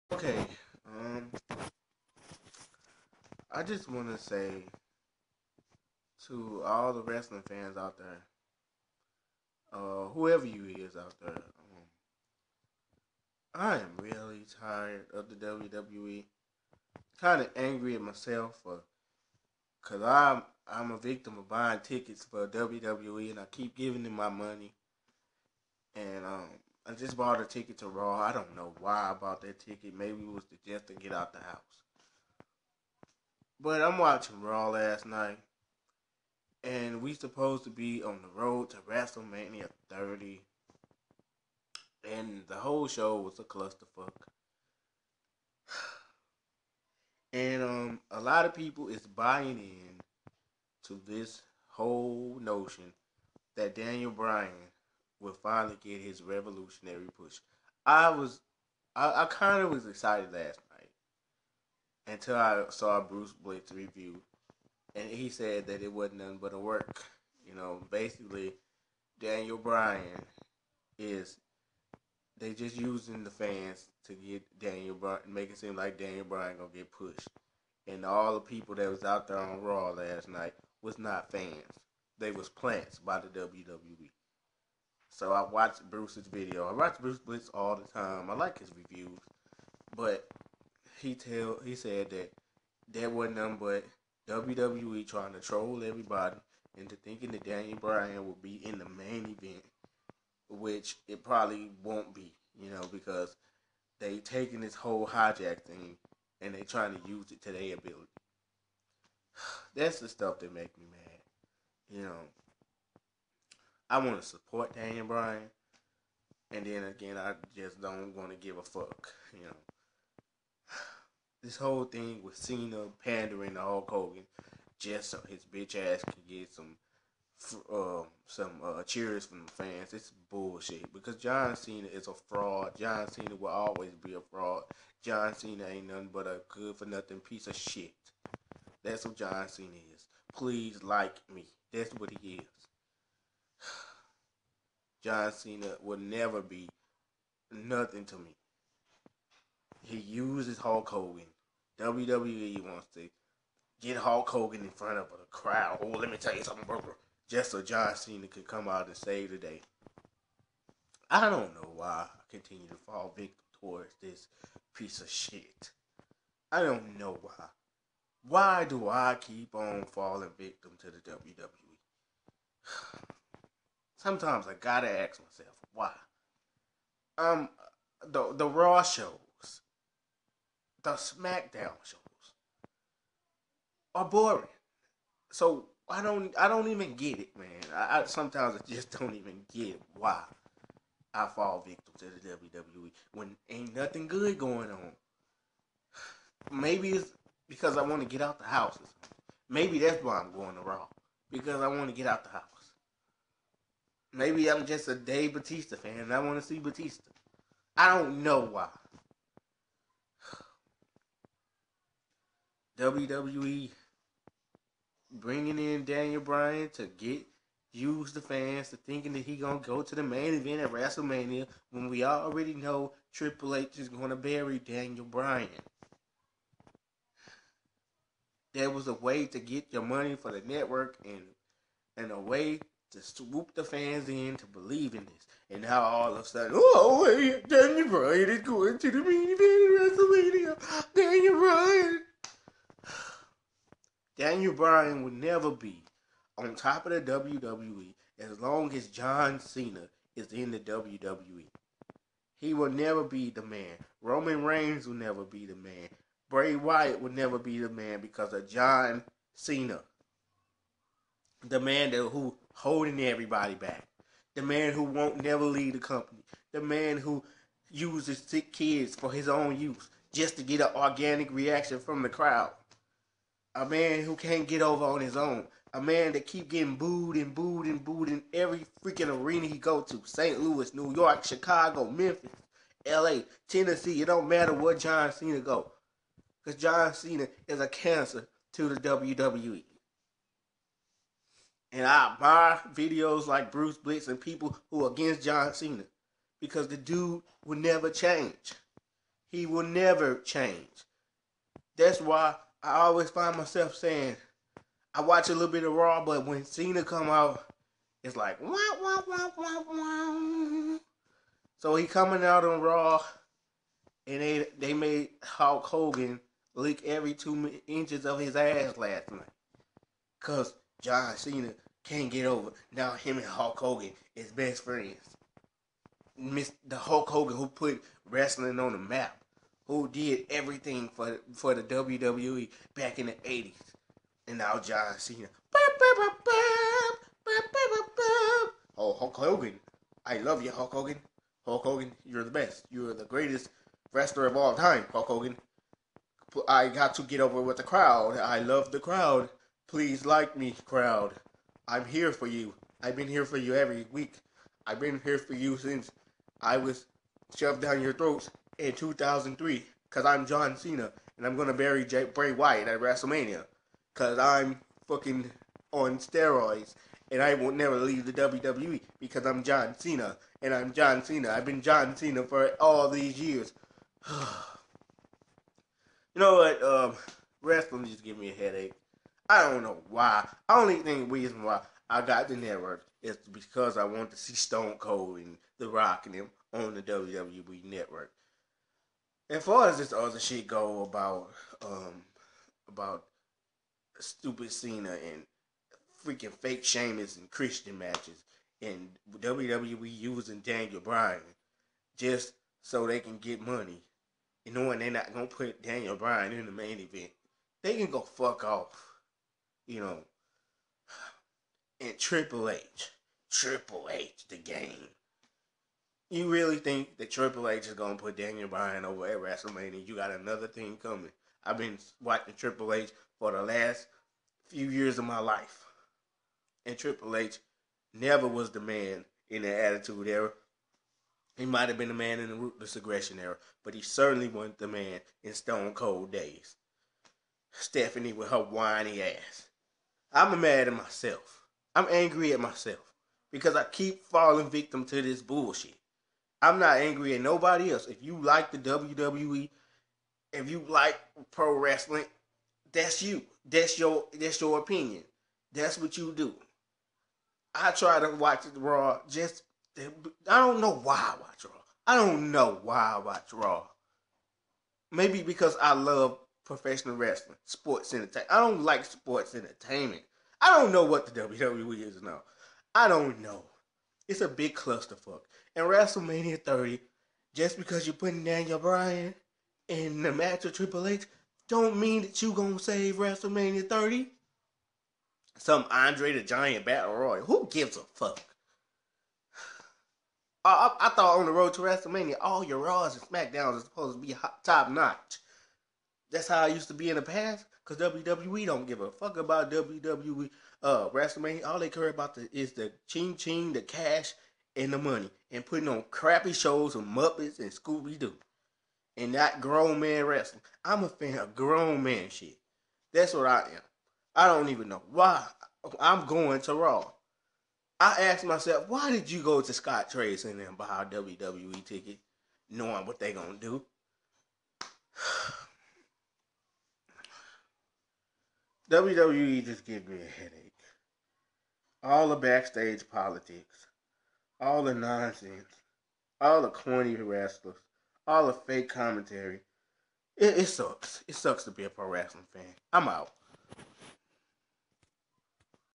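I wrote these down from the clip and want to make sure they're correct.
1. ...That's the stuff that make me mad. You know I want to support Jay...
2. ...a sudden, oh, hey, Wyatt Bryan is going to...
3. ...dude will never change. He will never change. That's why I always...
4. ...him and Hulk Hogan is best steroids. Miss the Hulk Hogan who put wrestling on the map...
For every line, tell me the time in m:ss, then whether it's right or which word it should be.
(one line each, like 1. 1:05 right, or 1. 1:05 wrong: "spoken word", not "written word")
1. 1:49 wrong: "Daniel", not "Jay"
2. 3:56 wrong: "Daniel", not "Wyatt"
3. 4:56 right
4. 5:22 wrong: "friends", not "steroids".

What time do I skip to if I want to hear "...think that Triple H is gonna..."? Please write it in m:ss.
6:56.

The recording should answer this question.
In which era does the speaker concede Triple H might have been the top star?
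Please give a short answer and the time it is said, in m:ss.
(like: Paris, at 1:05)
Ruthless Aggression Era, at 7:12.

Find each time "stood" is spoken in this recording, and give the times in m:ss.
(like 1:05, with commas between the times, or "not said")
not said.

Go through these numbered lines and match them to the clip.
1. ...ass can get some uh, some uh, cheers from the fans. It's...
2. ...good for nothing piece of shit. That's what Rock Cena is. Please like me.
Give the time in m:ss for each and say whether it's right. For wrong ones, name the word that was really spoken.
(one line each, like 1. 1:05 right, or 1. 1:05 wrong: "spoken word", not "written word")
1. 2:05 right
2. 2:16 wrong: "John", not "Rock".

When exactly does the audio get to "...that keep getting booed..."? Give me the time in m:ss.
4:36.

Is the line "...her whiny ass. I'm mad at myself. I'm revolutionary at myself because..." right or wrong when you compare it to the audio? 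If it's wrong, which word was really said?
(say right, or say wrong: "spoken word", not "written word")
wrong: "angry", not "revolutionary".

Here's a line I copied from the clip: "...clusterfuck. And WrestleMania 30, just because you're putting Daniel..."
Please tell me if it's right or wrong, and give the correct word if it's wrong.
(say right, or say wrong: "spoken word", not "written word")
right.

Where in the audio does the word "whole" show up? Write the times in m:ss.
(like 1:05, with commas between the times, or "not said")
0:42, 0:51, 1:44, 2:01.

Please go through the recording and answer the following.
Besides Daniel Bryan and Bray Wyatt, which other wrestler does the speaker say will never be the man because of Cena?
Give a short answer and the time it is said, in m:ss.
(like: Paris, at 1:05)
Roman Reigns, at 4:14.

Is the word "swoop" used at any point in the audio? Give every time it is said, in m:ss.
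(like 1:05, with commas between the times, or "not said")
3:53.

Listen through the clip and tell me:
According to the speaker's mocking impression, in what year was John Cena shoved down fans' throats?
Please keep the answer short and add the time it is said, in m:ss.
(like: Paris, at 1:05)
2003, at 5:58.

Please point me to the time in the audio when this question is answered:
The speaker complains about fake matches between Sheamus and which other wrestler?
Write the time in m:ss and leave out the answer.
6:37.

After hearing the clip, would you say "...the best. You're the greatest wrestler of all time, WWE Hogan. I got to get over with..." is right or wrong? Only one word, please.
wrong.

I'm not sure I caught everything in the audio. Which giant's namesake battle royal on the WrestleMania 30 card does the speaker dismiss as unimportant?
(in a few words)
Andre the Giant.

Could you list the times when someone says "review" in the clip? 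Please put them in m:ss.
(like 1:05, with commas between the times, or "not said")
1:03, 1:28.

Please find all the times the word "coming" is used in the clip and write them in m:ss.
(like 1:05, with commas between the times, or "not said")
5:11, 7:00.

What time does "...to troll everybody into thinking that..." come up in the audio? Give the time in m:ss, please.
1:35.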